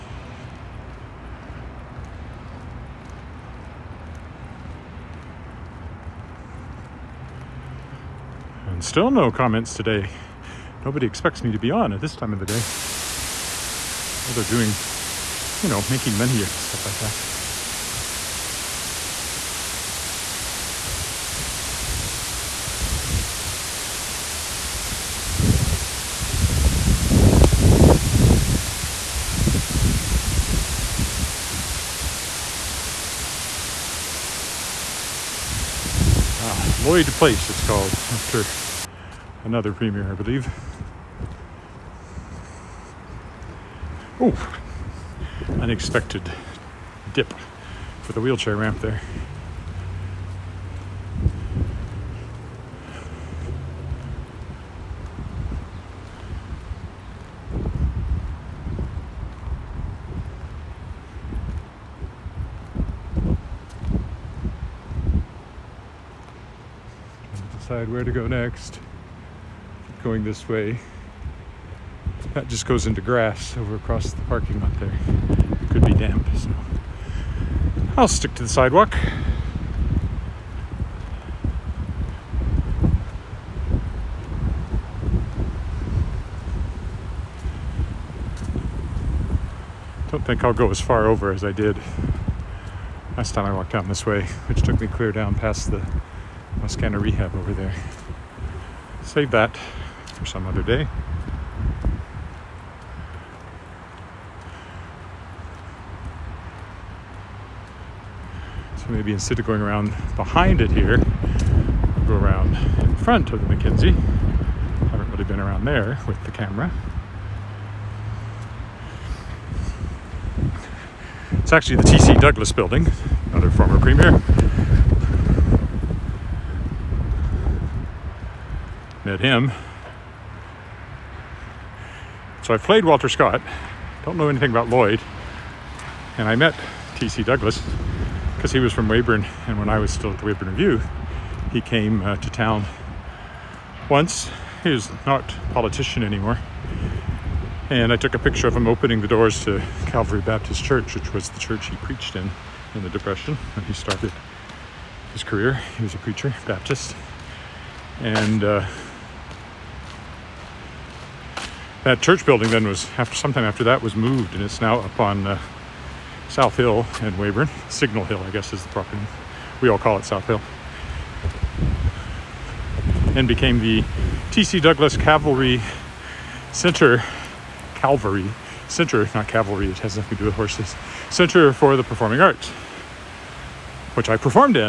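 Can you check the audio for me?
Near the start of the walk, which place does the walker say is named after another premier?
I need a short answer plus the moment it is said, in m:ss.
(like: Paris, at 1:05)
Lloyd Place, at 0:36.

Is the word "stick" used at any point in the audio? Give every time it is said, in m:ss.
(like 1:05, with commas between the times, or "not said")
1:18.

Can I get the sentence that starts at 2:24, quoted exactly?
He was not a politician anymore.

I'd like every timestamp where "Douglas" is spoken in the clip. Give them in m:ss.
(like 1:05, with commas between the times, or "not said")
2:02, 2:17, 2:54.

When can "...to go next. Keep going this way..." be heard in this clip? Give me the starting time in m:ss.
1:08.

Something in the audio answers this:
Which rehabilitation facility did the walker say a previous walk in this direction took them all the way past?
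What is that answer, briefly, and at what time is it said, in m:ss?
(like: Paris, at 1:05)
Wascana Rehab, at 1:36.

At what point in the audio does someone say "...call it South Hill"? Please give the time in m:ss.
2:49.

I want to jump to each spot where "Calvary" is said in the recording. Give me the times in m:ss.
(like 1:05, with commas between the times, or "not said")
2:29, 2:57.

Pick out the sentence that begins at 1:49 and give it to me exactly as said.
instead of going around behind it here, go around in front of the i Haven't really been around there with the camera.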